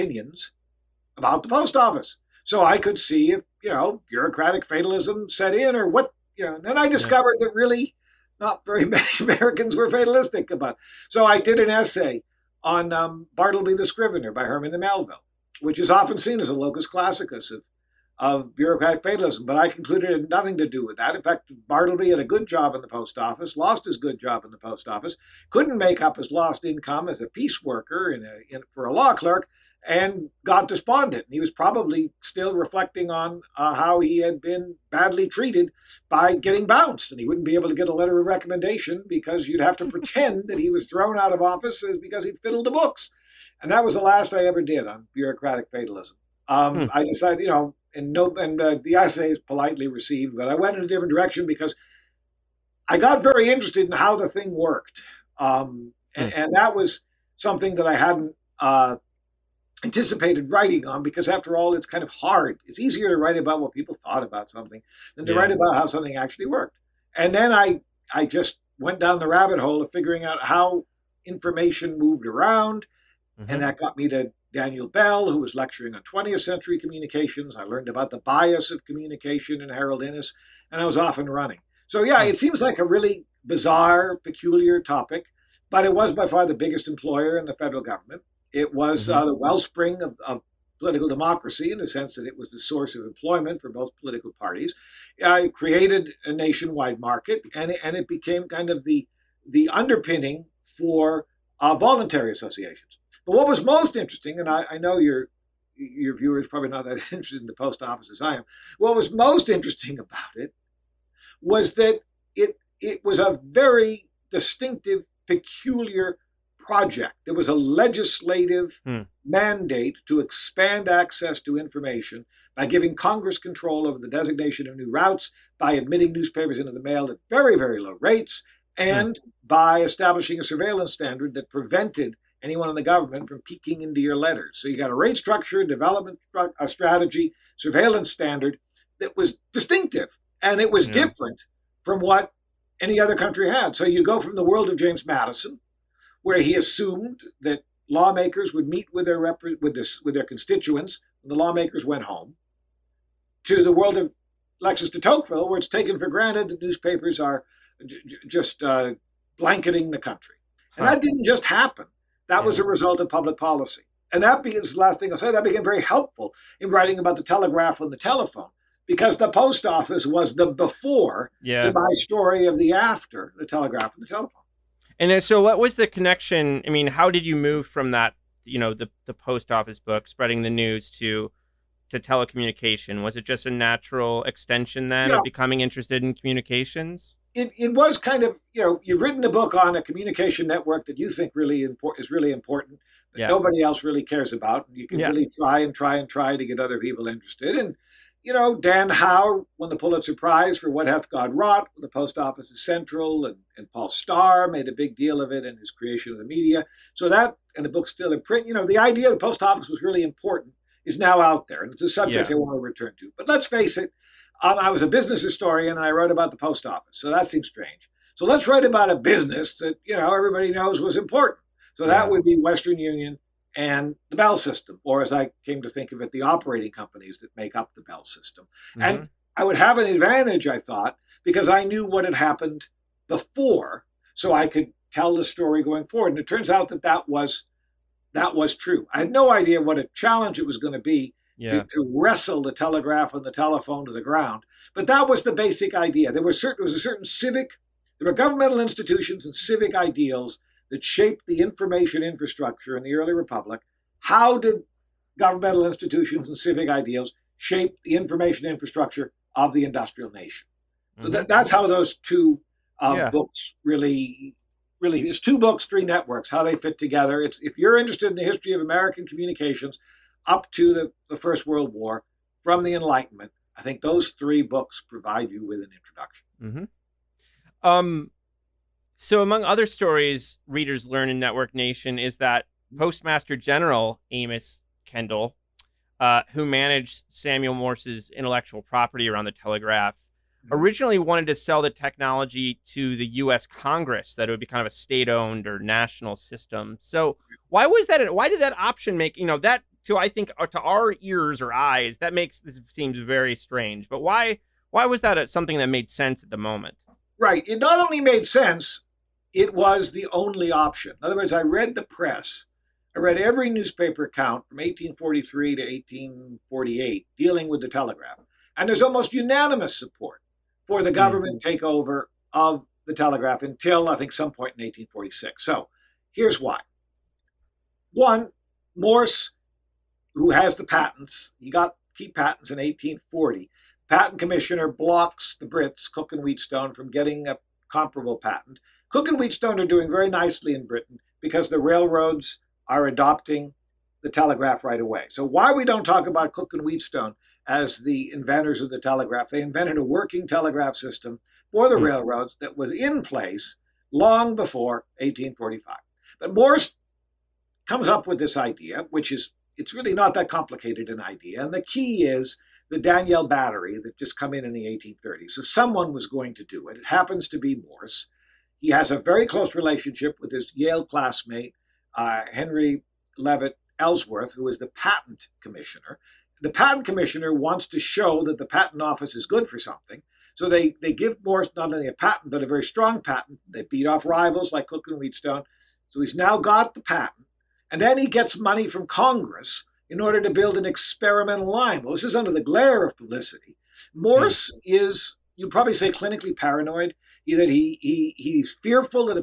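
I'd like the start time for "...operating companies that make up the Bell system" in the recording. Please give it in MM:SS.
03:46.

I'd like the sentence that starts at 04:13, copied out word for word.
How did governmental institutions and civic ideals shape the information infrastructure of the industrial nation?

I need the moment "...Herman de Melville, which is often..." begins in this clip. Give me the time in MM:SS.
00:14.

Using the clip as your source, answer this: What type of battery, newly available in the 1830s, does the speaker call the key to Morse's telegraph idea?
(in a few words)
Daniell battery.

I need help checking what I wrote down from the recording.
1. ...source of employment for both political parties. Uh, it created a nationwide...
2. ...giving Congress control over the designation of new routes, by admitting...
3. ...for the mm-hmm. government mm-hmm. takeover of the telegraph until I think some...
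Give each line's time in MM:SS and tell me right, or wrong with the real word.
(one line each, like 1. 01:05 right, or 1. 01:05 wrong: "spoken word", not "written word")
1. 01:32 right
2. 02:02 right
3. 05:20 right.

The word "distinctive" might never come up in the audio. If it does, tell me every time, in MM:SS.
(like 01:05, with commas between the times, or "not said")
01:54, 02:19.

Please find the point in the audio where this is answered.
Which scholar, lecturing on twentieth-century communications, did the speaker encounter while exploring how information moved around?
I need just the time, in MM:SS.
01:14.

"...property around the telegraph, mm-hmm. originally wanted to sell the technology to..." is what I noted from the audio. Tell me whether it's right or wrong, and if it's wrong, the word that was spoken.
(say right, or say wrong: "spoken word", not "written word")
right.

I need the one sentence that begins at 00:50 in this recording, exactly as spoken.
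But I went in a different direction because I got very interested in how the thing worked, um, and, hmm.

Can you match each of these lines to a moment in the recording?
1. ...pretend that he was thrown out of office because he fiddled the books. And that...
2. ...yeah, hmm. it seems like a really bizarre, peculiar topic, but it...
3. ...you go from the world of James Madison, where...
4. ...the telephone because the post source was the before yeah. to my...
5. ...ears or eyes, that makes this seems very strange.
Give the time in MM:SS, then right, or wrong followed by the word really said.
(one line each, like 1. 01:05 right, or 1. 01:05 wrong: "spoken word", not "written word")
1. 00:39 right
2. 01:22 right
3. 02:23 right
4. 02:47 wrong: "office", not "source"
5. 05:01 right.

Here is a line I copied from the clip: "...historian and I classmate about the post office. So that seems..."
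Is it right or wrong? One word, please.
wrong.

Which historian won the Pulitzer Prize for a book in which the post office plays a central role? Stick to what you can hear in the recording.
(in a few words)
Dan Howe.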